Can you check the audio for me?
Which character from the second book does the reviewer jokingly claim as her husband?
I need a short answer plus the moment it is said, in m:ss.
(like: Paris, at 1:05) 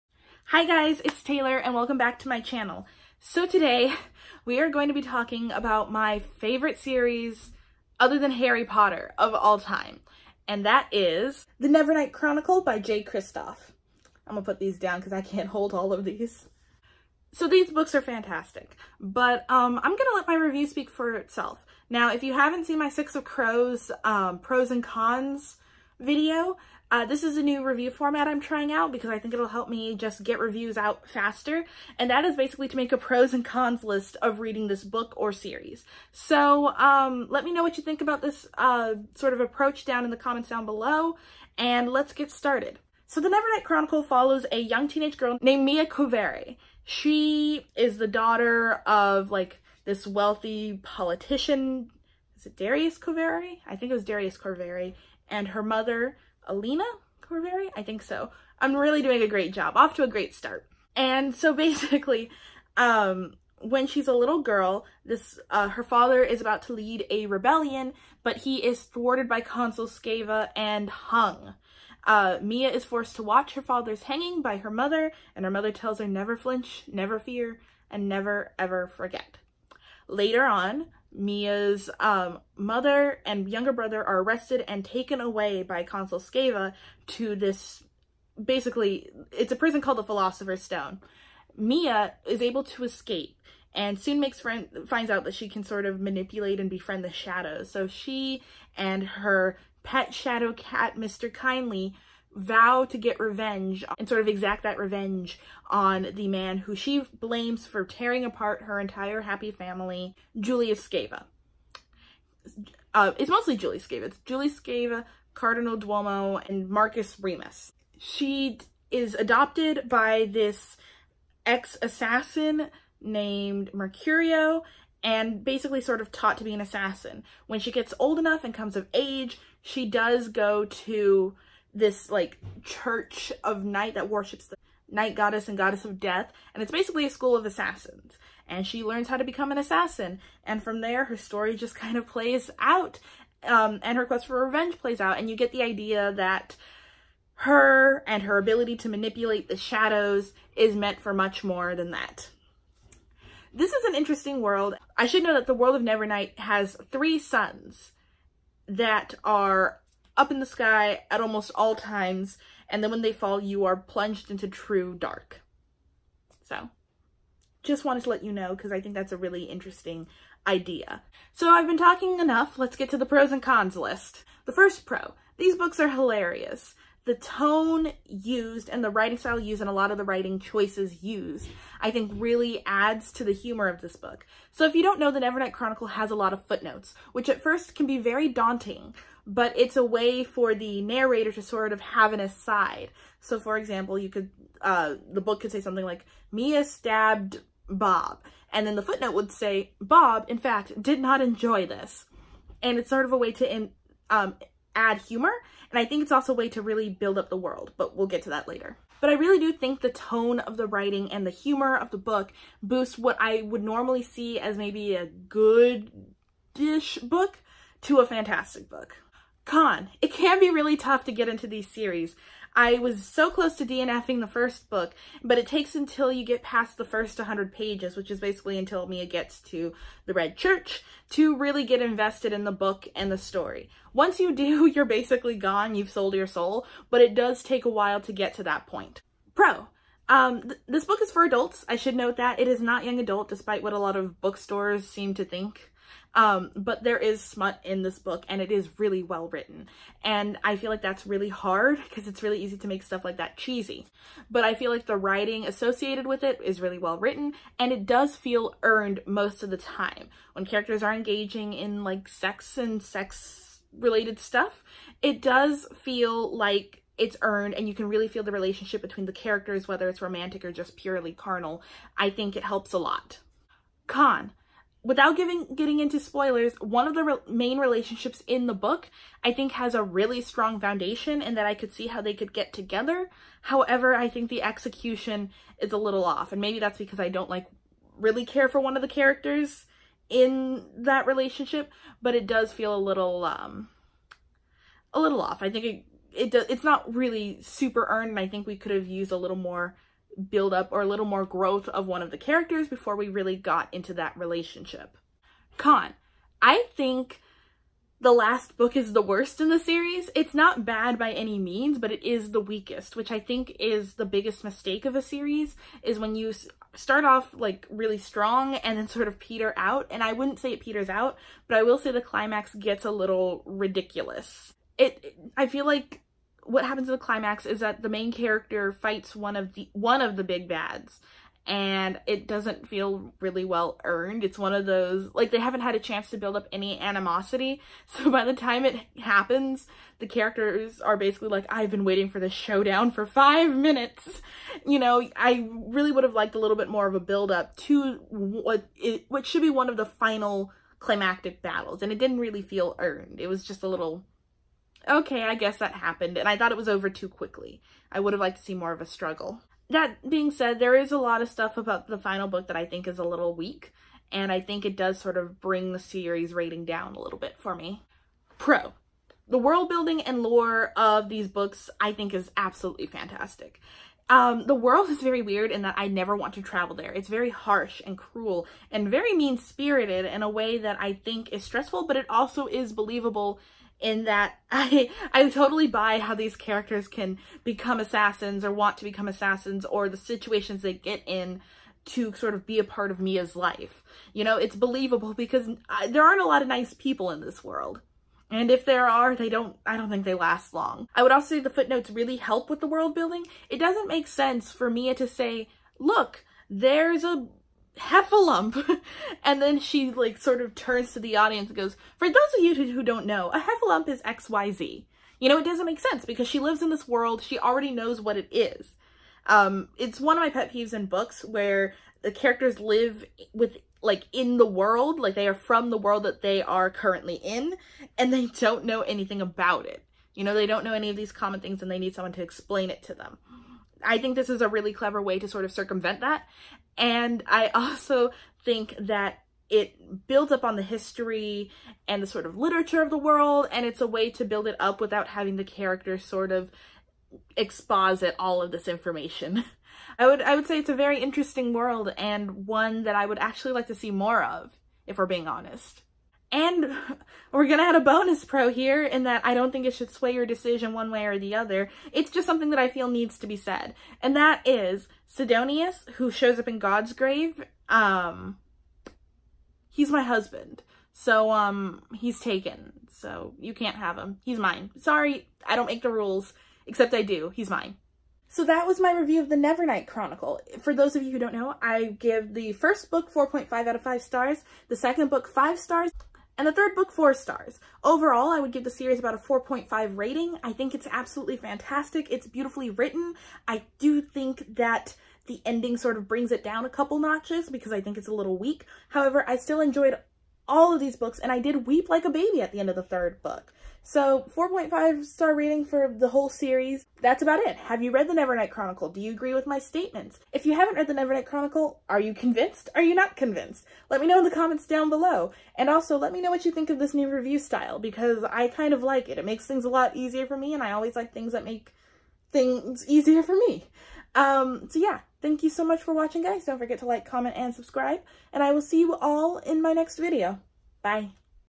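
Sidonius, at 7:45.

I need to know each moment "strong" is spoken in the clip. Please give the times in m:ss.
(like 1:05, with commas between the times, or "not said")
4:40, 5:17.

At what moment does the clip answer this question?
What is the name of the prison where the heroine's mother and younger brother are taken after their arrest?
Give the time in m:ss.
1:30.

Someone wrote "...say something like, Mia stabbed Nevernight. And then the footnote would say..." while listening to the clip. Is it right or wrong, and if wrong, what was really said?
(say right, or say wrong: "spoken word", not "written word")
wrong: "Bob", not "Nevernight".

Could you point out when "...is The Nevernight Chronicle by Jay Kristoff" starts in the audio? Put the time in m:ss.
0:10.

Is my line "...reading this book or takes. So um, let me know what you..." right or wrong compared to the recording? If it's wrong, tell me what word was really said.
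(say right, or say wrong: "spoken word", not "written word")
wrong: "series", not "takes".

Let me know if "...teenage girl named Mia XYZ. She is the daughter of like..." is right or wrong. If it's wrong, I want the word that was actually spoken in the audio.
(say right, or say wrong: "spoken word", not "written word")
wrong: "Corvere", not "XYZ".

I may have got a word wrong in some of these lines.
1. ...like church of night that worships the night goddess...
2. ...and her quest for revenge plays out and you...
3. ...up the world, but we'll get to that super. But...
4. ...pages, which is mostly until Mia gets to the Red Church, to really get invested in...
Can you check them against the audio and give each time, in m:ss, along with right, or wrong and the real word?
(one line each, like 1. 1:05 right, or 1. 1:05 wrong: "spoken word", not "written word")
1. 2:12 right
2. 2:23 right
3. 3:27 wrong: "later", not "super"
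4. 3:47 wrong: "basically", not "mostly".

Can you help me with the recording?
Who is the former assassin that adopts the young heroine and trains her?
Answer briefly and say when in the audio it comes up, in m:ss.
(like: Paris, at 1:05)
Mercurio, at 2:03.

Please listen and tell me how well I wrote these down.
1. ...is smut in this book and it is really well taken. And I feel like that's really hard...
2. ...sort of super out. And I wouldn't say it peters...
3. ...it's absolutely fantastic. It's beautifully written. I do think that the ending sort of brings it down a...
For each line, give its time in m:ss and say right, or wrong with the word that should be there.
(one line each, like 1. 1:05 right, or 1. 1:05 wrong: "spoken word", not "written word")
1. 4:06 wrong: "written", not "taken"
2. 5:18 wrong: "peter", not "super"
3. 8:10 right.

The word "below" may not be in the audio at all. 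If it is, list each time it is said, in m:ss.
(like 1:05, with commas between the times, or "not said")
0:40, 8:34.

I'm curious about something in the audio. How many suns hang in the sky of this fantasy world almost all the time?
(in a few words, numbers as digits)
3.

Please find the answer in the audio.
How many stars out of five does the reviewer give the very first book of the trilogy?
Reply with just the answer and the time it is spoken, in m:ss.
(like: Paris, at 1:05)
4.5, at 8:03.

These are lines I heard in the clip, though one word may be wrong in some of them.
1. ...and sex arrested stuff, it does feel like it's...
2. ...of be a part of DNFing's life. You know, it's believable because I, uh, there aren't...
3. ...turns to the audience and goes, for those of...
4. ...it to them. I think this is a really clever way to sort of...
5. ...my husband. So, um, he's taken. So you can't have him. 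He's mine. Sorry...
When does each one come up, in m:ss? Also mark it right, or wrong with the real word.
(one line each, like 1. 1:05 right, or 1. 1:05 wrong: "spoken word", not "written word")
1. 4:22 wrong: "related", not "arrested"
2. 6:32 wrong: "Mia", not "DNFing"
3. 6:50 right
4. 7:12 right
5. 7:49 right.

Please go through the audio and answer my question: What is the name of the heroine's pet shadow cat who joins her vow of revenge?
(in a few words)
Mr. Kindly.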